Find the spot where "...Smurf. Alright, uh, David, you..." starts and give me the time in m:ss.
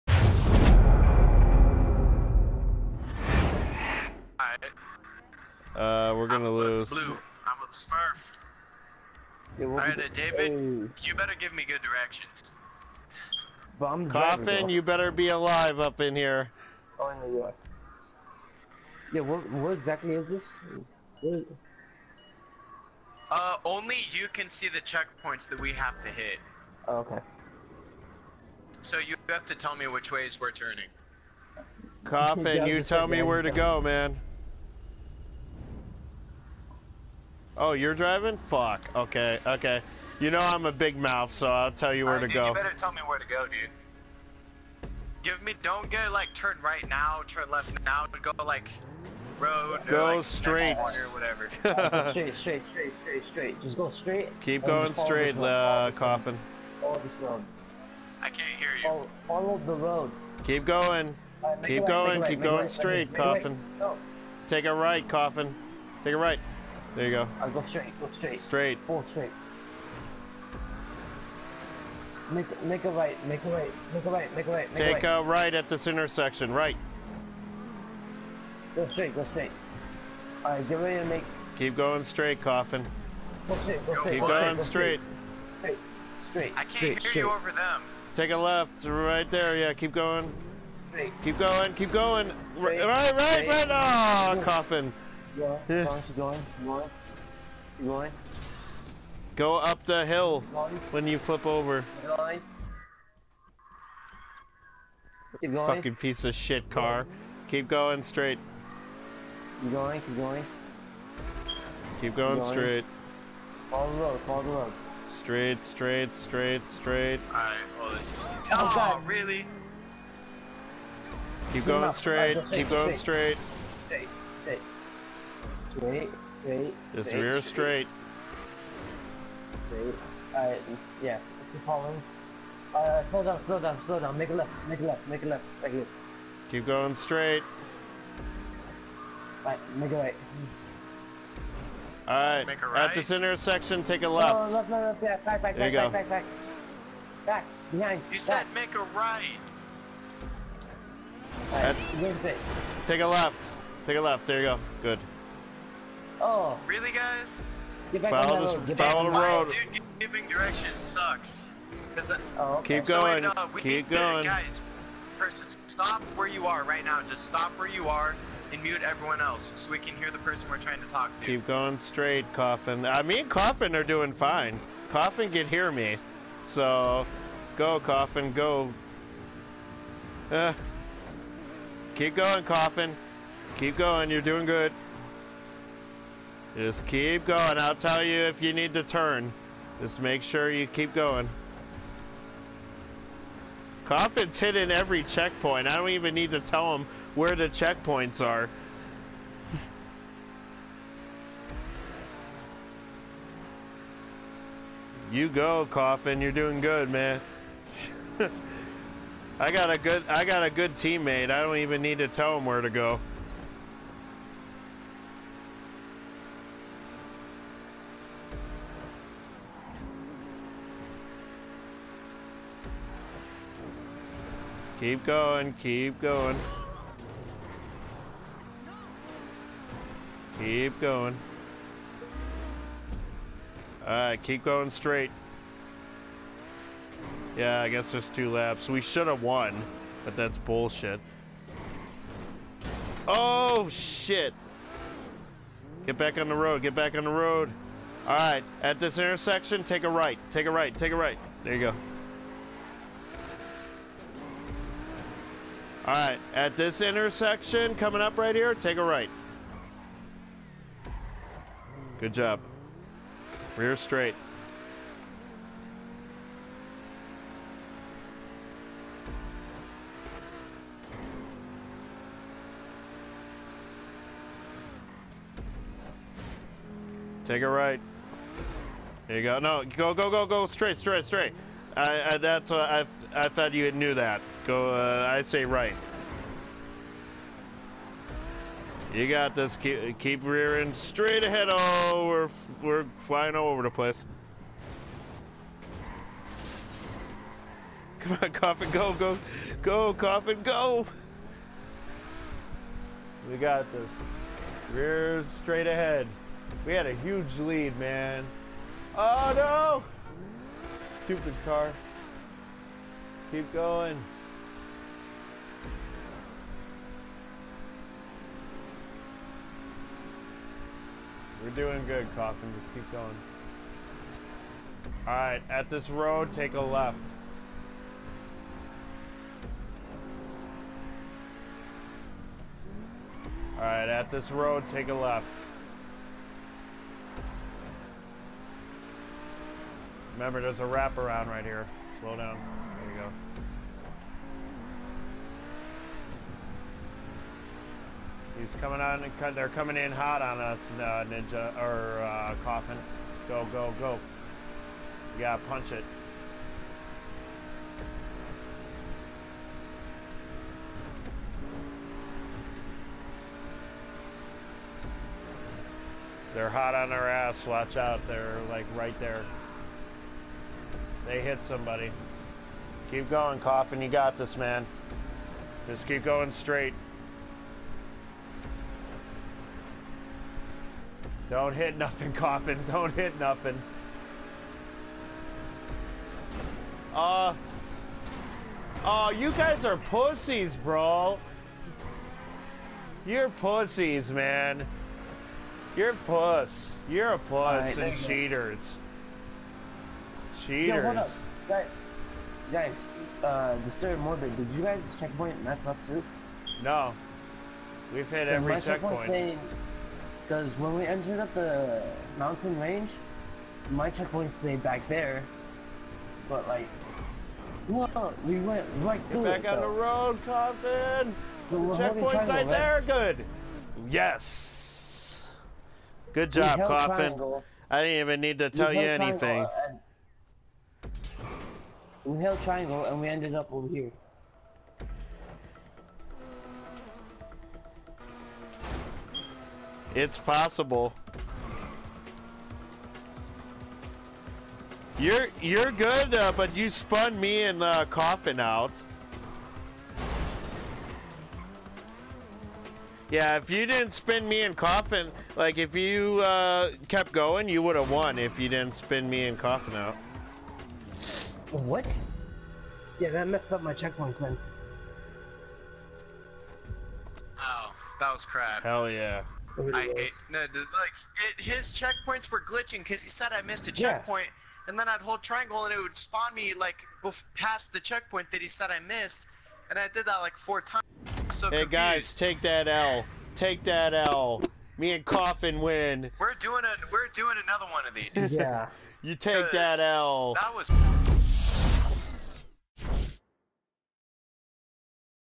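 0:07.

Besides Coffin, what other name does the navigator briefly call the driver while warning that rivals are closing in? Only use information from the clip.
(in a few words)
Ninja.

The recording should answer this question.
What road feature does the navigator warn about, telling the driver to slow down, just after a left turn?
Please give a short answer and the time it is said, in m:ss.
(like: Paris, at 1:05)
A wraparound, at 5:40.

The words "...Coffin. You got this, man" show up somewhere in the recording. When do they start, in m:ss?
6:13.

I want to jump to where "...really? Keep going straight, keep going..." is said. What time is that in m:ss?
1:59.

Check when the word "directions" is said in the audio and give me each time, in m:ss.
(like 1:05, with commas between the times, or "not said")
0:11, 2:40.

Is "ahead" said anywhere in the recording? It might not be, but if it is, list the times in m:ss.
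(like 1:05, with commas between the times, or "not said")
4:51, 5:05.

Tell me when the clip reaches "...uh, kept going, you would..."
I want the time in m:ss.
7:36.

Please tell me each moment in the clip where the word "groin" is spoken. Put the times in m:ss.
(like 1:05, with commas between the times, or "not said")
not said.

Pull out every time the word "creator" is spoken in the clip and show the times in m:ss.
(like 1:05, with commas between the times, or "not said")
not said.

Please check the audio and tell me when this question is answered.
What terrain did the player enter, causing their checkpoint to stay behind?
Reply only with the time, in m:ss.
6:52.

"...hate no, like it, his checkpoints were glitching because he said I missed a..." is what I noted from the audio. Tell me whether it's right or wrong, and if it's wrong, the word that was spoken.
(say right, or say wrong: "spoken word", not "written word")
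right.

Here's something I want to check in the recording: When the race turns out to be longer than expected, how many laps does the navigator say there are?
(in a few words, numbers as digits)
2.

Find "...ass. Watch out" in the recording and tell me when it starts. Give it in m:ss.
6:07.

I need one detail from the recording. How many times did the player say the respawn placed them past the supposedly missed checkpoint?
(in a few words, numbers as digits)
4.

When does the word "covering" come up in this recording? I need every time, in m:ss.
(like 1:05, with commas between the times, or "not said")
not said.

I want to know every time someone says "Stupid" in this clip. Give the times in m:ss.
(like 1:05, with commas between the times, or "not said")
5:10.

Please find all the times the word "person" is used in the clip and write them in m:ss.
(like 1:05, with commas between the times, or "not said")
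2:45, 2:50.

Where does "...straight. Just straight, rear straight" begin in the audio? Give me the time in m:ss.
2:06.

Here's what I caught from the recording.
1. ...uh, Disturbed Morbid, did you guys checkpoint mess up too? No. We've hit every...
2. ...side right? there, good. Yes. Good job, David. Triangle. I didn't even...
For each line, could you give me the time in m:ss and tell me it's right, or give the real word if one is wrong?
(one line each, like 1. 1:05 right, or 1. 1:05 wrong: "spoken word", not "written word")
1. 6:43 right
2. 7:02 wrong: "Coffin", not "David".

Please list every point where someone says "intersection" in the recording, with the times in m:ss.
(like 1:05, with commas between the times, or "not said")
1:15, 2:23, 4:08, 4:16.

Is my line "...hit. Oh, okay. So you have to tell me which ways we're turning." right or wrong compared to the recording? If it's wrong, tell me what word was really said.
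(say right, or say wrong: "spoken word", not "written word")
right.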